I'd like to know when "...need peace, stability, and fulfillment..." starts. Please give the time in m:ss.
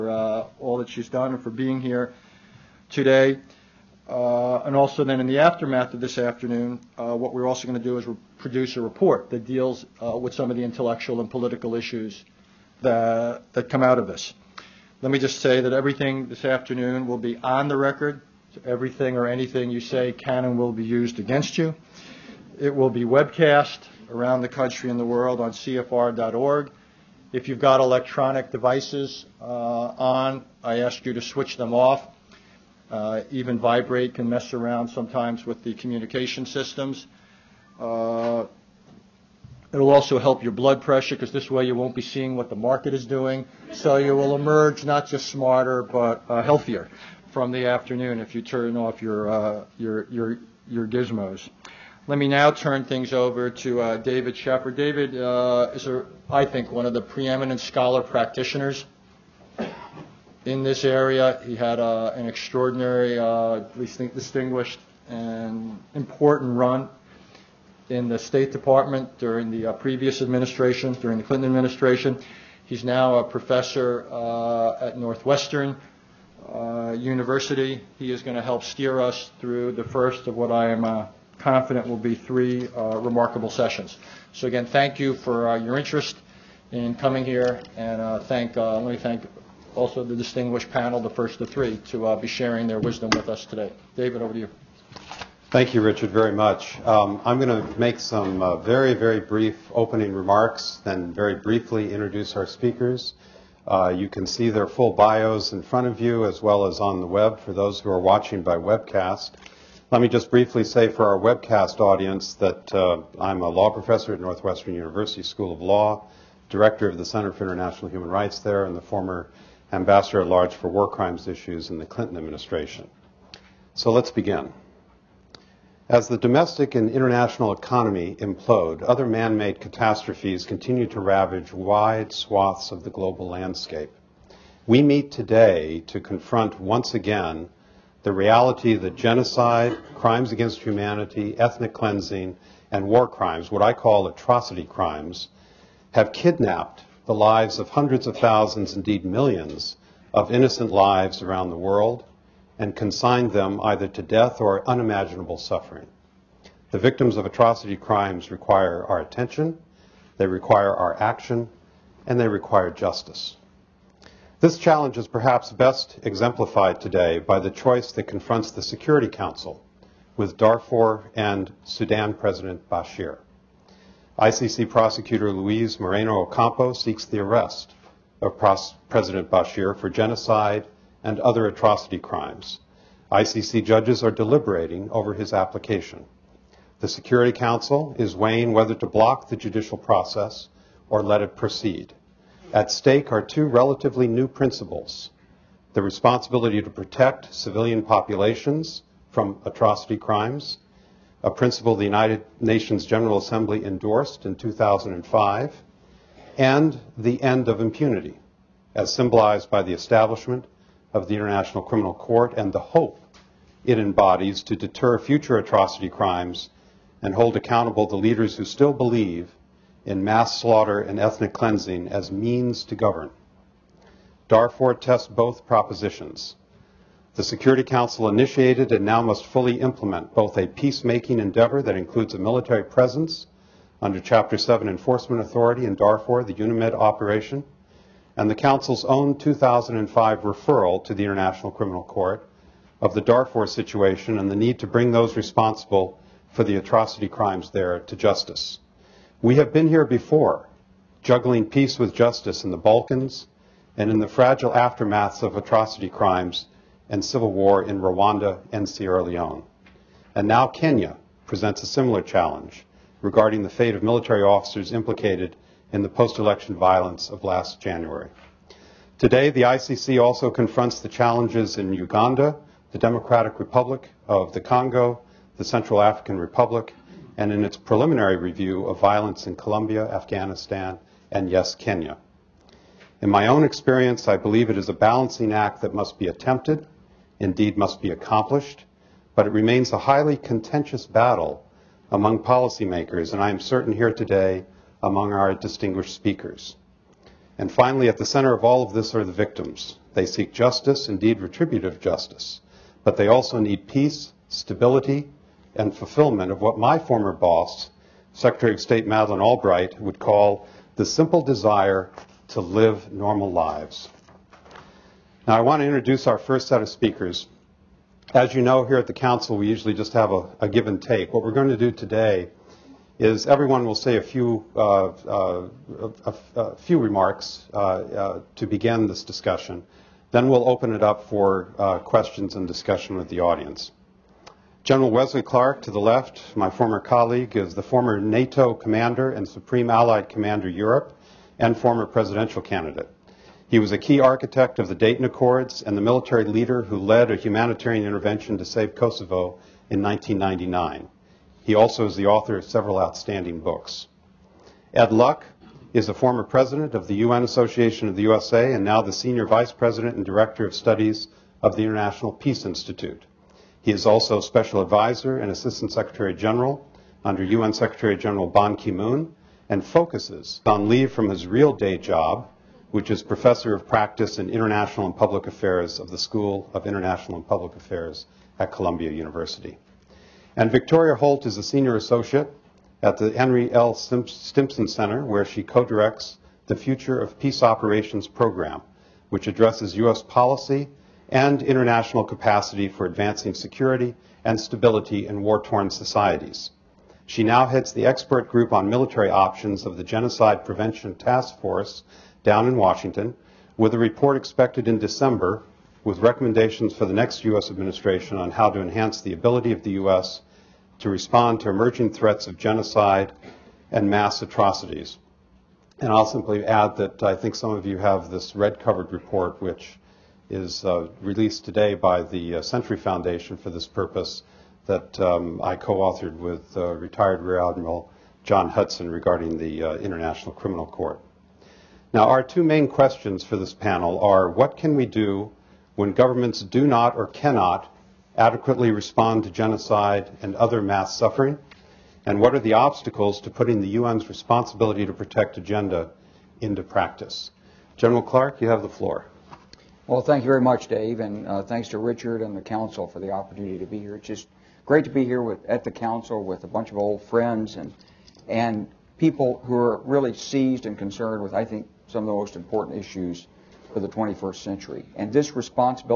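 5:03.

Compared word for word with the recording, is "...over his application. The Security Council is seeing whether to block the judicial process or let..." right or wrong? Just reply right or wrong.
wrong.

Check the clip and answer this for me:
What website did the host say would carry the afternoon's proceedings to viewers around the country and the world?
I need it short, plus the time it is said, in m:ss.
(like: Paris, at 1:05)
CFR.org, at 0:25.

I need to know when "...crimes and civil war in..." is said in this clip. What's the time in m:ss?
4:15.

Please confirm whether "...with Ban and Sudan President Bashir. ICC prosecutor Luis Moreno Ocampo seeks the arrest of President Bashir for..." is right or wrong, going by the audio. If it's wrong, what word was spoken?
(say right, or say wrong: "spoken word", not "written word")
wrong: "Darfur", not "Ban".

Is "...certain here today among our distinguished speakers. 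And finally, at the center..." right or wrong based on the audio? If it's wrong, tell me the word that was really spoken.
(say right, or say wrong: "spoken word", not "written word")
right.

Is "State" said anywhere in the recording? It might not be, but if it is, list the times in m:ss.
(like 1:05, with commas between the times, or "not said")
1:08, 5:08.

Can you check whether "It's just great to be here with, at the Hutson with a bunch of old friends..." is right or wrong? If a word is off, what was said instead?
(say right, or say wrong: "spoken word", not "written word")
wrong: "Council", not "Hutson".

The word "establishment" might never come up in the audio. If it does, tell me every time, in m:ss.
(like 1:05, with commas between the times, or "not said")
3:29.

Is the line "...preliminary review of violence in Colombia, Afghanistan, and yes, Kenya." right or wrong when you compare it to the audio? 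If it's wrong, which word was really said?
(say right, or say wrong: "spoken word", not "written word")
right.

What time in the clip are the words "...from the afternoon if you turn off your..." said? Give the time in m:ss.
0:47.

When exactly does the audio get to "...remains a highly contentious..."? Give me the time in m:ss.
4:49.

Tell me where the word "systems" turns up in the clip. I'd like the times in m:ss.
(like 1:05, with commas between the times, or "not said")
0:36.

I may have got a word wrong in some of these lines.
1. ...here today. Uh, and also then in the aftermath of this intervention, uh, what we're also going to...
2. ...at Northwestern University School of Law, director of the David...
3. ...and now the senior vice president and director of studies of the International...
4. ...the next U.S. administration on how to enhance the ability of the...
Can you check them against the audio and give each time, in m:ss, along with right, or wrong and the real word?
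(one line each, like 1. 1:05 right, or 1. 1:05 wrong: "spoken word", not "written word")
1. 0:01 wrong: "afternoon", not "intervention"
2. 1:54 wrong: "Center", not "David"
3. 5:58 right
4. 6:46 right.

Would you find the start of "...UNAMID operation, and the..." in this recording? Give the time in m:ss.
3:56.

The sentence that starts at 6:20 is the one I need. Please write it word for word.
And Victoria Holt is a senior associate at the Henry L.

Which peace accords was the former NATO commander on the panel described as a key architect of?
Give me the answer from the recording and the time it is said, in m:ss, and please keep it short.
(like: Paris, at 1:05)
Dayton Accords, at 5:44.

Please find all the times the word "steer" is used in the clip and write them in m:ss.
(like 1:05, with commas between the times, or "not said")
1:18.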